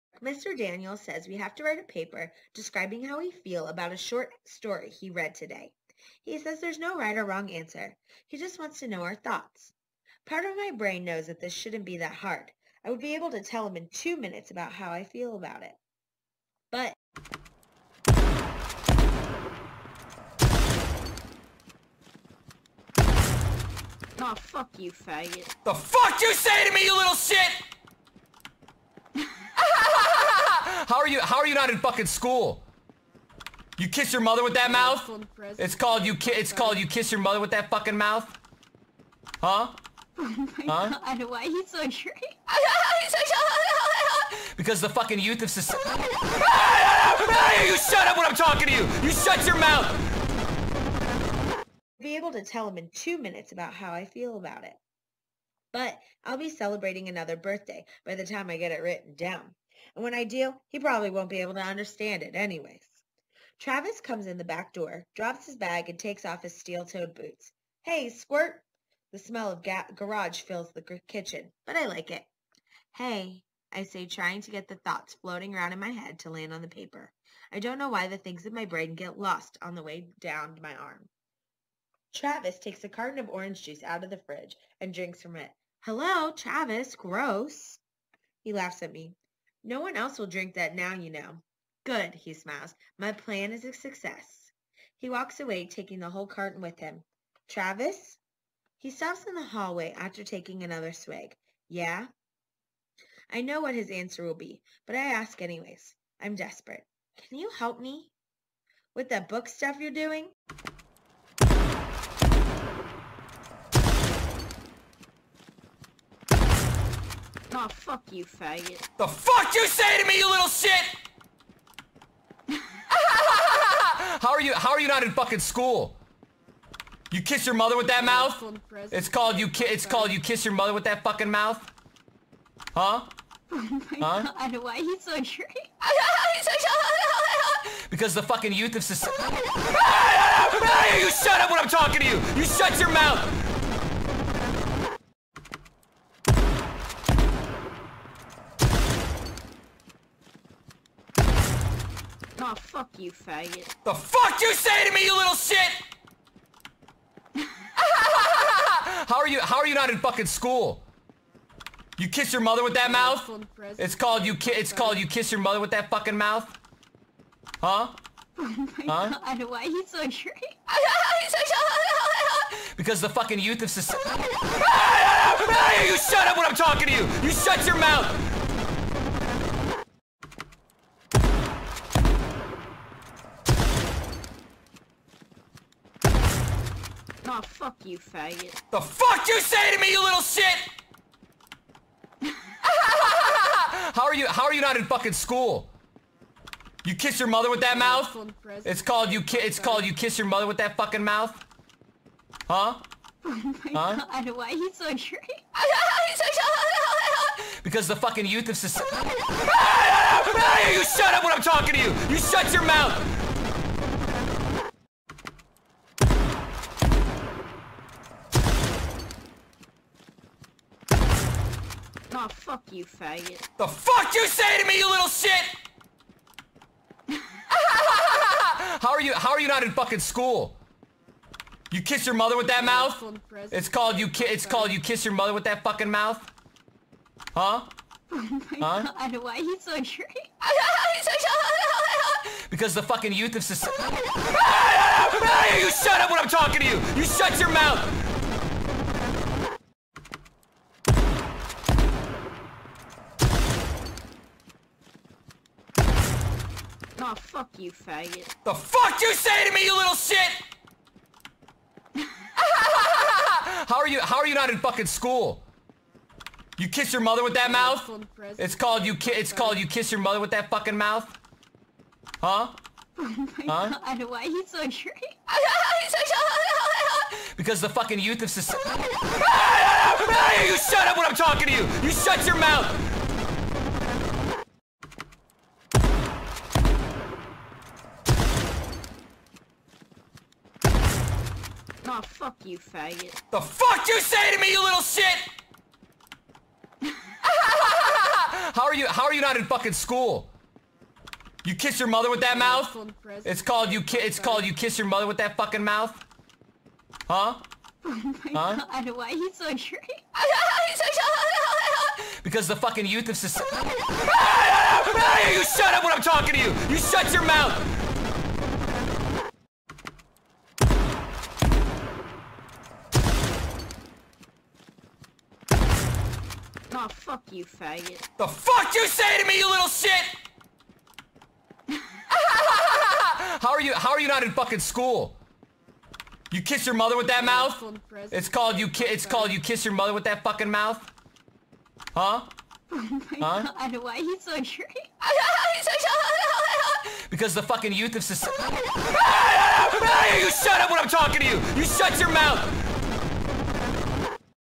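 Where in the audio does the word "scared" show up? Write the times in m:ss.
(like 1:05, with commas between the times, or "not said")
not said.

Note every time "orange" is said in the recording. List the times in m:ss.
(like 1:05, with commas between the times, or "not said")
1:23.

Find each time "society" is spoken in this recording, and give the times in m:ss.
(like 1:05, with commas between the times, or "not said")
0:45, 2:18, 2:53, 3:28, 4:03, 4:38, 5:13, 5:48.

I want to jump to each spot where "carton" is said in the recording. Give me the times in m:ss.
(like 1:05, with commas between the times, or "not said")
1:22, 1:36.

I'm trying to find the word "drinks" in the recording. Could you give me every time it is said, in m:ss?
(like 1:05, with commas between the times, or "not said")
1:24, 1:30.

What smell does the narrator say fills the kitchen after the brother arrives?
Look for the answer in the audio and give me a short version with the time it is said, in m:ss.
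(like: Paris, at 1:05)
garage, at 1:09.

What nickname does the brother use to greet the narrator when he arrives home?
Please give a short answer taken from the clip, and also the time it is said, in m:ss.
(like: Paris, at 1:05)
Squirt, at 1:08.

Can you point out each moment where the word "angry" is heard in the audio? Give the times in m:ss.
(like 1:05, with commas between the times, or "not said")
3:24, 5:09.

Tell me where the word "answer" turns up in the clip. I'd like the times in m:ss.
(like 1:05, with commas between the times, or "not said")
0:07, 1:43.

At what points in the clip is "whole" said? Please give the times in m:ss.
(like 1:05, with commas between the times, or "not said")
1:36.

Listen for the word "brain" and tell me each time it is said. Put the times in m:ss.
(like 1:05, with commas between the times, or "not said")
0:10, 1:18.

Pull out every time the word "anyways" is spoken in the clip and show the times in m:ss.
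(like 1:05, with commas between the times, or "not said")
1:02, 1:45.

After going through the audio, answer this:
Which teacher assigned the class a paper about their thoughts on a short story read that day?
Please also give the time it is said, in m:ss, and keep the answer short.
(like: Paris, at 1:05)
Mr. Daniel, at 0:00.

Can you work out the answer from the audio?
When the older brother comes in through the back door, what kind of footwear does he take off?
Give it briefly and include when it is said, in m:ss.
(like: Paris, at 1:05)
steel-toed boots, at 1:06.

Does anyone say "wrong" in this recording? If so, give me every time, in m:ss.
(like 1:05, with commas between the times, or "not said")
0:07.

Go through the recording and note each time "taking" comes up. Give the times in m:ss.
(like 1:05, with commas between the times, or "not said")
1:35, 1:40.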